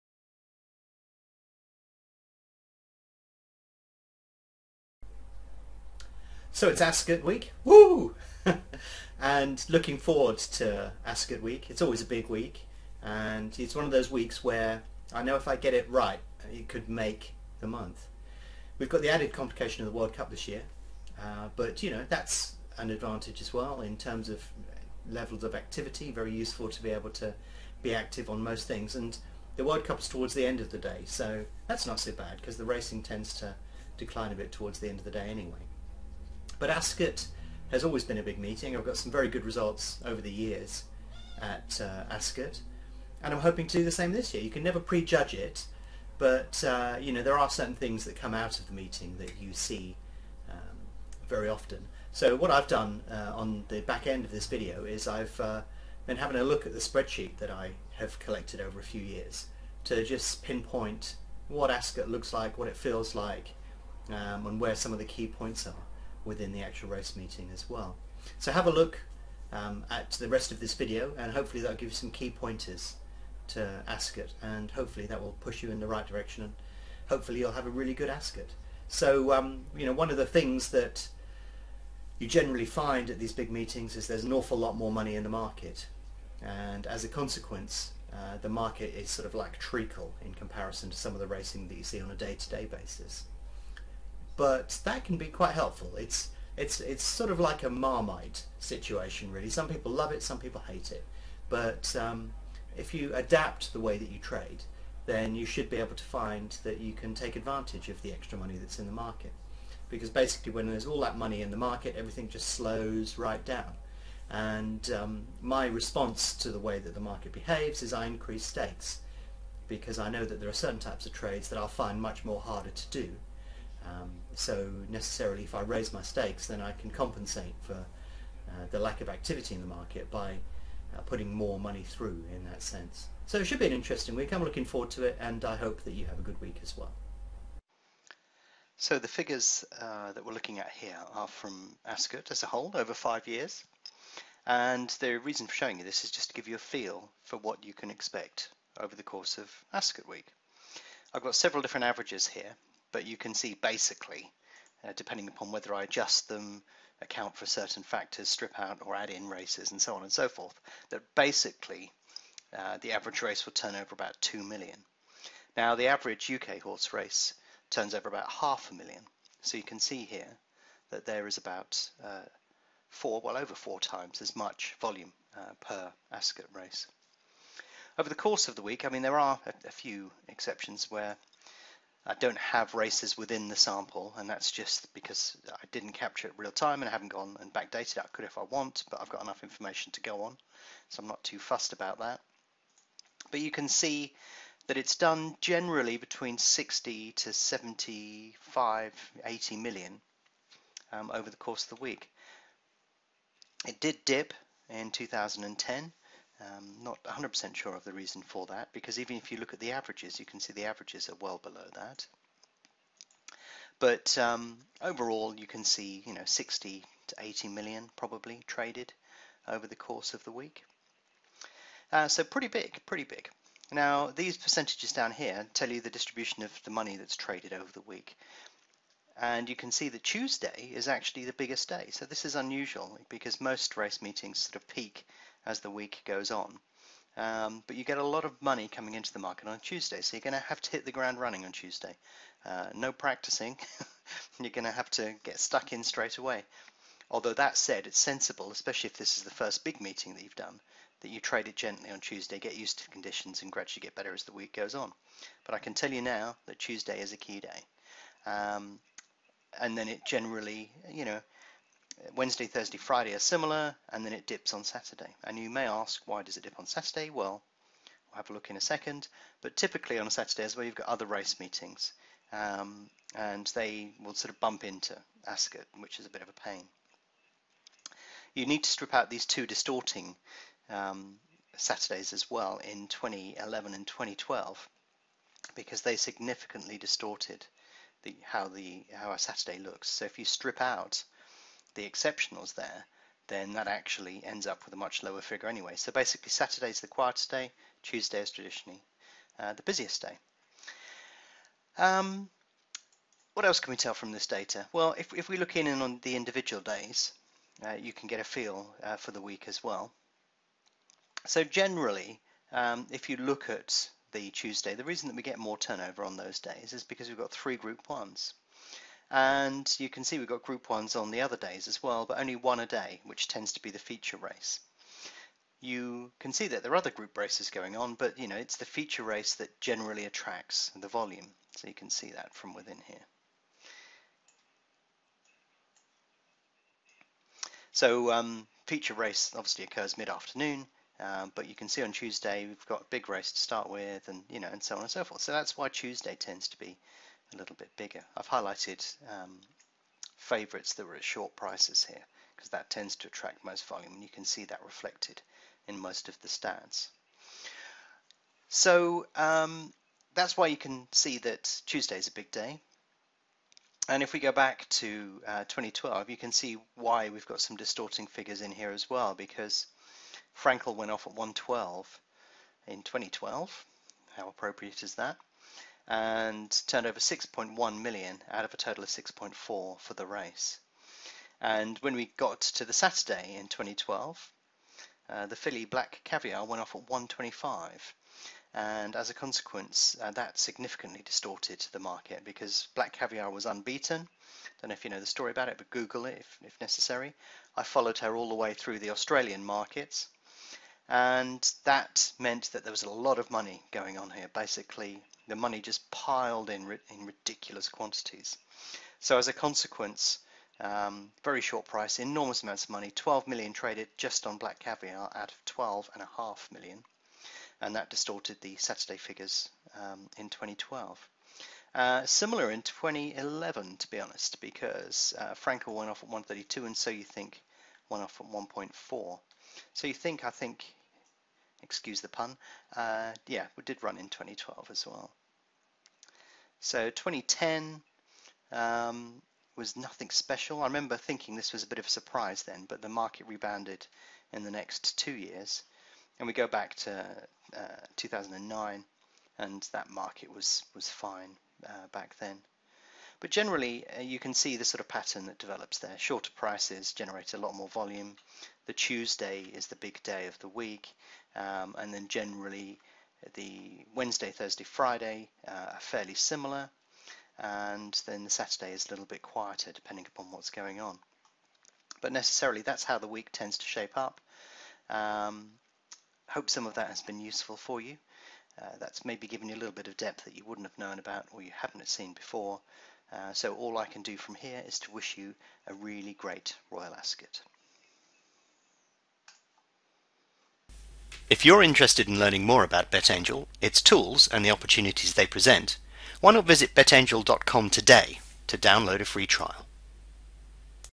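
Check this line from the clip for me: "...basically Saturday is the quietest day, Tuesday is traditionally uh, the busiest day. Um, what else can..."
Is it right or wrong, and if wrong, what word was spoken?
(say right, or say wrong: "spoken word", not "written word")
right.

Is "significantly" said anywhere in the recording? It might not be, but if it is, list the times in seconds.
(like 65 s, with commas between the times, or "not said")
285 s, 390 s.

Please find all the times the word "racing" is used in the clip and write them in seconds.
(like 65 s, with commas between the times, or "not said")
32 s, 91 s.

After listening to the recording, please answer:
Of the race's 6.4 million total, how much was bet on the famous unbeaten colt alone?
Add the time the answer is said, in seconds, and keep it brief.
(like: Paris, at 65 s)
6.1 million, at 376 s.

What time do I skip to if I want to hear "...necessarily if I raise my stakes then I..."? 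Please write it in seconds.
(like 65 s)
124 s.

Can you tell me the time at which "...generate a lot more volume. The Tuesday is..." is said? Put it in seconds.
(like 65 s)
456 s.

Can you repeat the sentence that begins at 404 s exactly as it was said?
Basically, the money just piled in, in ridiculous quantities.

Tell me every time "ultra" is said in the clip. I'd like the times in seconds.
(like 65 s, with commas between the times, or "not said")
not said.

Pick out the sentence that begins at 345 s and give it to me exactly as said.
So that's why Tuesday tends to be a little bit bigger.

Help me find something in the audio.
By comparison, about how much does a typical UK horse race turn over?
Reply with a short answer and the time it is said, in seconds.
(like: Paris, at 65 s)
half a million, at 168 s.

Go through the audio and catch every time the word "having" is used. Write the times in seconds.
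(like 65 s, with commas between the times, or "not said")
56 s.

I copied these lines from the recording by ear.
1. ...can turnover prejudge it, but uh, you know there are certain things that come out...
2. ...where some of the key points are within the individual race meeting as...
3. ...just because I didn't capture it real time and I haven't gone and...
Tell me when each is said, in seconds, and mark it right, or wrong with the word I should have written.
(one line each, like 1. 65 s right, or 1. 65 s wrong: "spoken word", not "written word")
1. 44 s wrong: "never", not "turnover"
2. 64 s wrong: "actual", not "individual"
3. 184 s right.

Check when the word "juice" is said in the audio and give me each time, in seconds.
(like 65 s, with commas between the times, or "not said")
not said.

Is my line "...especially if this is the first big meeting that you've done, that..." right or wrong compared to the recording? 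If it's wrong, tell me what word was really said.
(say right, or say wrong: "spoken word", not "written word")
right.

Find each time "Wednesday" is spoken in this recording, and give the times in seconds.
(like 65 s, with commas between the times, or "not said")
262 s, 463 s.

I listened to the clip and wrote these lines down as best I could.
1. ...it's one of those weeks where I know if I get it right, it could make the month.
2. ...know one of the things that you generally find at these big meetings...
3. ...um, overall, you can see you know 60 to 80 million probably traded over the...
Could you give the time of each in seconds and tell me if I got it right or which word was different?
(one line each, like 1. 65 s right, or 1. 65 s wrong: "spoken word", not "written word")
1. 13 s right
2. 79 s right
3. 214 s right.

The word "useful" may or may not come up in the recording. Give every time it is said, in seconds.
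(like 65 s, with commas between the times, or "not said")
26 s, 477 s.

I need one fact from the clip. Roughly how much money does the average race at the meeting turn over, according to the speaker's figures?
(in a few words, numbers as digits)
2 million.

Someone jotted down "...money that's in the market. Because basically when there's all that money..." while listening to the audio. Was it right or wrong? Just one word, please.
right.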